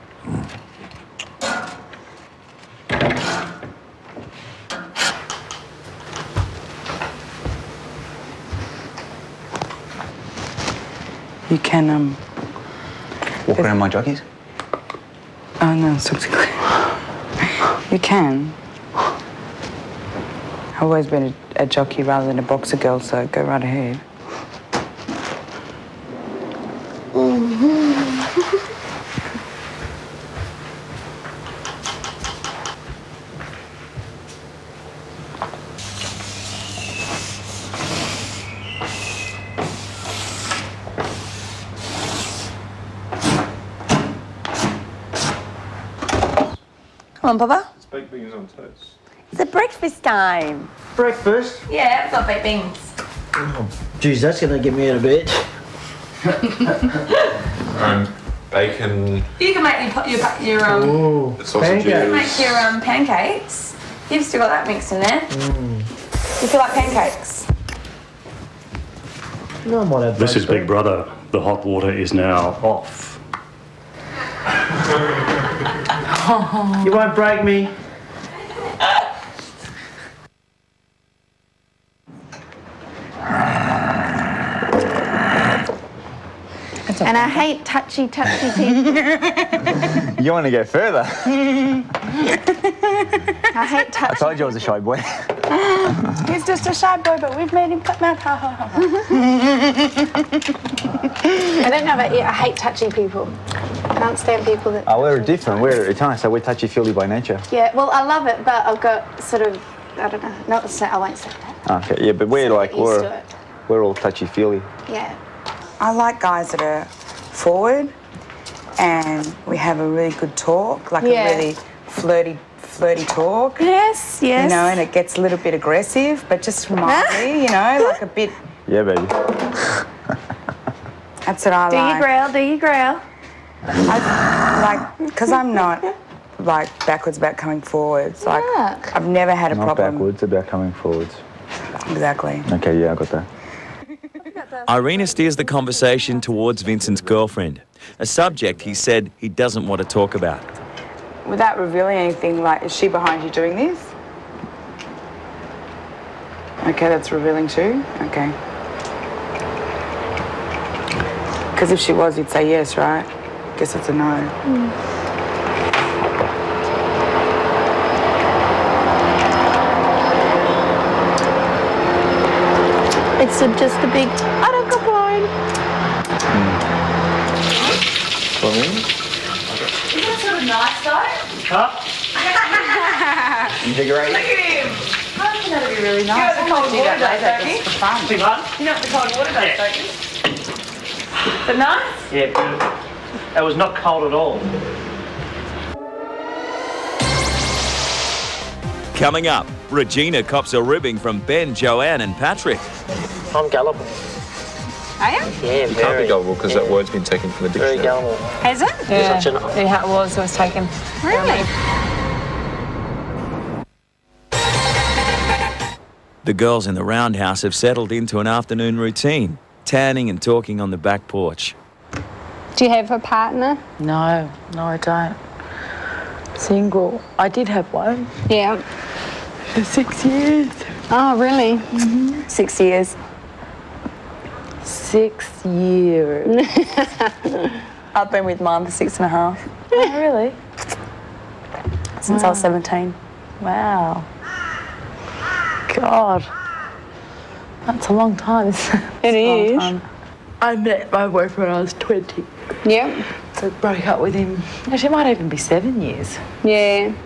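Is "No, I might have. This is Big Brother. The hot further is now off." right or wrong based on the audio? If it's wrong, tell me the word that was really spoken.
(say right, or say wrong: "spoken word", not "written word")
wrong: "water", not "further".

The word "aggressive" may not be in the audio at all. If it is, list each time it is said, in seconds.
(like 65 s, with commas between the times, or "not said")
125 s.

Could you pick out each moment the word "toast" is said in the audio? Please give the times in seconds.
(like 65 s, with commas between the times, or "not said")
48 s.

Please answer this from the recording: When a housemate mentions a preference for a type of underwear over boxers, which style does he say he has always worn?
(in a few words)
Jockey.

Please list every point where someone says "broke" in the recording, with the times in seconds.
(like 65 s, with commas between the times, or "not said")
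253 s.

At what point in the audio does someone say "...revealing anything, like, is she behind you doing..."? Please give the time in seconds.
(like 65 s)
151 s.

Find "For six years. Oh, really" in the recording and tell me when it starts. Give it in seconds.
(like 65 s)
229 s.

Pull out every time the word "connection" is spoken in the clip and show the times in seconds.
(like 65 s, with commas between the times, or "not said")
not said.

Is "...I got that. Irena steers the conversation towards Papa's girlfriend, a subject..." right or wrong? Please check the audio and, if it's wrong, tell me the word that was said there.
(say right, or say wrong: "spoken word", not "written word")
wrong: "Vincent", not "Papa".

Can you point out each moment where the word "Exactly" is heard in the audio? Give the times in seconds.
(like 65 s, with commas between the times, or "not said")
141 s.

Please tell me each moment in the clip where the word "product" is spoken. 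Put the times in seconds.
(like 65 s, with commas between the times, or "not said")
not said.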